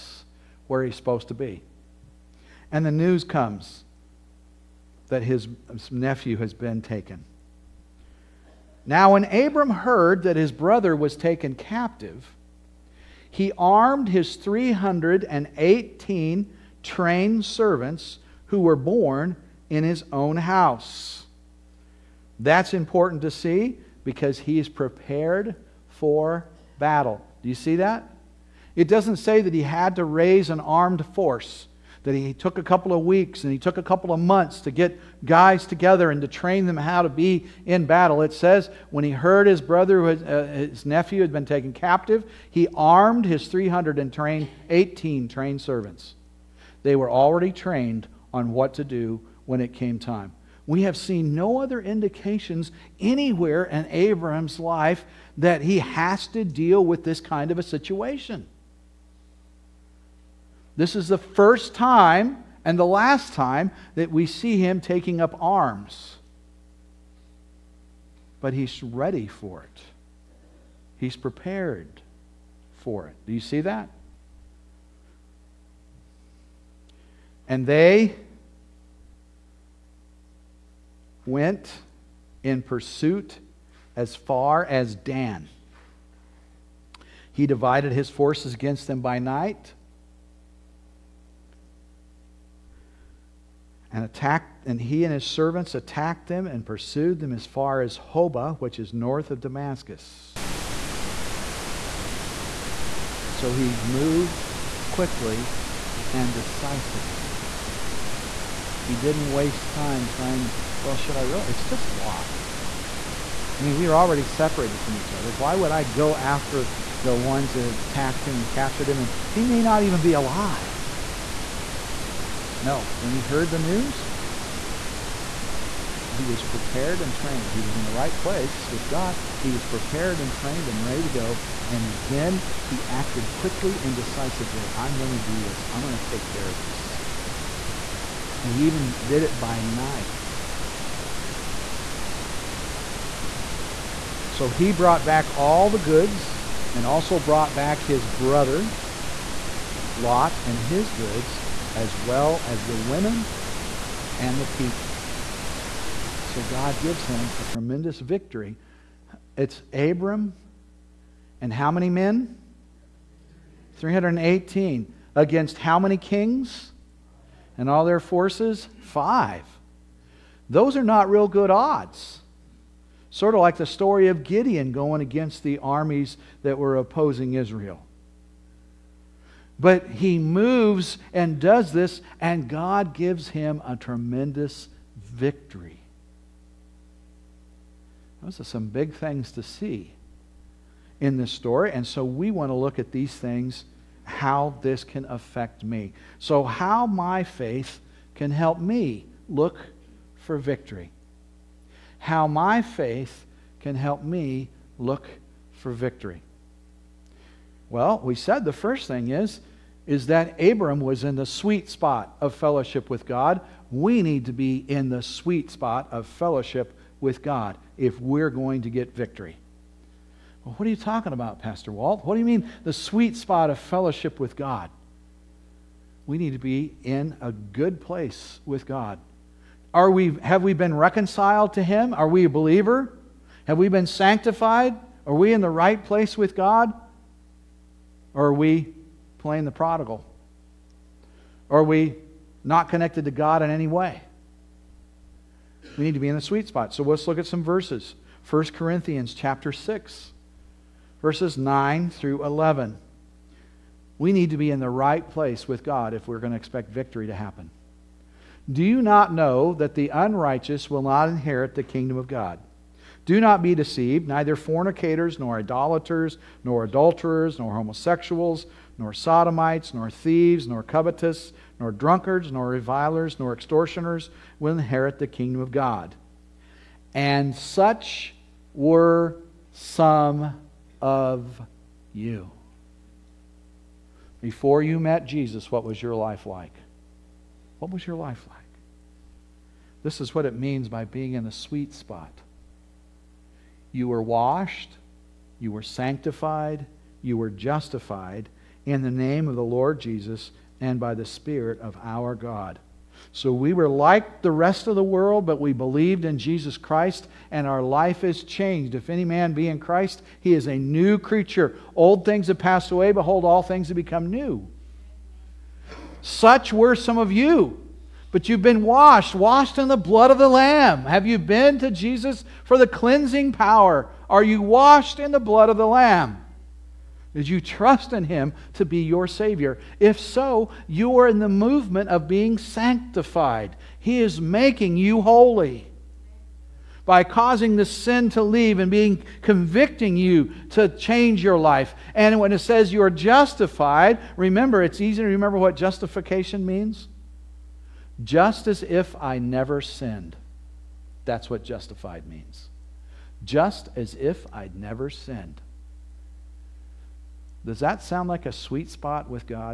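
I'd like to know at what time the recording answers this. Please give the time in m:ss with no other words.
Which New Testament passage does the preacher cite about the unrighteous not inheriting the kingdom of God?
4:08.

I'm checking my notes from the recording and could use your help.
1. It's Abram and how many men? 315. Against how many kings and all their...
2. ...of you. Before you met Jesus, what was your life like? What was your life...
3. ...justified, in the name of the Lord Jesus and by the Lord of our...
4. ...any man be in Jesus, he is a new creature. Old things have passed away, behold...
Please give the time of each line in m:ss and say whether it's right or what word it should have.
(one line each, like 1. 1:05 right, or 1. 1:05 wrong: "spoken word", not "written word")
1. 2:39 wrong: "318", not "315"
2. 4:40 right
3. 4:57 wrong: "Spirit", not "Lord"
4. 5:08 wrong: "Christ", not "Jesus".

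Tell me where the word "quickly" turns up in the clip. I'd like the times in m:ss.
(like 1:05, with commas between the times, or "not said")
1:44, 2:13.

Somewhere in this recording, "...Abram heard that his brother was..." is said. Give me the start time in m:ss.
0:09.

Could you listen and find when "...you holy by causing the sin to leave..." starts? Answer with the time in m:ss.
5:34.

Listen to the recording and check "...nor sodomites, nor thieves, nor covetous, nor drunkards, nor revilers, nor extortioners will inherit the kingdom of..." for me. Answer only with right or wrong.
right.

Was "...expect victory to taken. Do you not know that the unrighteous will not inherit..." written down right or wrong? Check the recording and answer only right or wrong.
wrong.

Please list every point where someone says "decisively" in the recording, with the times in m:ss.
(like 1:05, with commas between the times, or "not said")
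1:46, 2:13.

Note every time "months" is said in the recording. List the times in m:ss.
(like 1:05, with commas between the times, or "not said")
0:34.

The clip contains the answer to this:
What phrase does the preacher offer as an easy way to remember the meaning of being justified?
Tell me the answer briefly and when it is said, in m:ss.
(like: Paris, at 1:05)
Just as if I never sinned, at 5:48.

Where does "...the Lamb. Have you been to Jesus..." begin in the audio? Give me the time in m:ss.
5:20.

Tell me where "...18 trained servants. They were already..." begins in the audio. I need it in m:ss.
0:44.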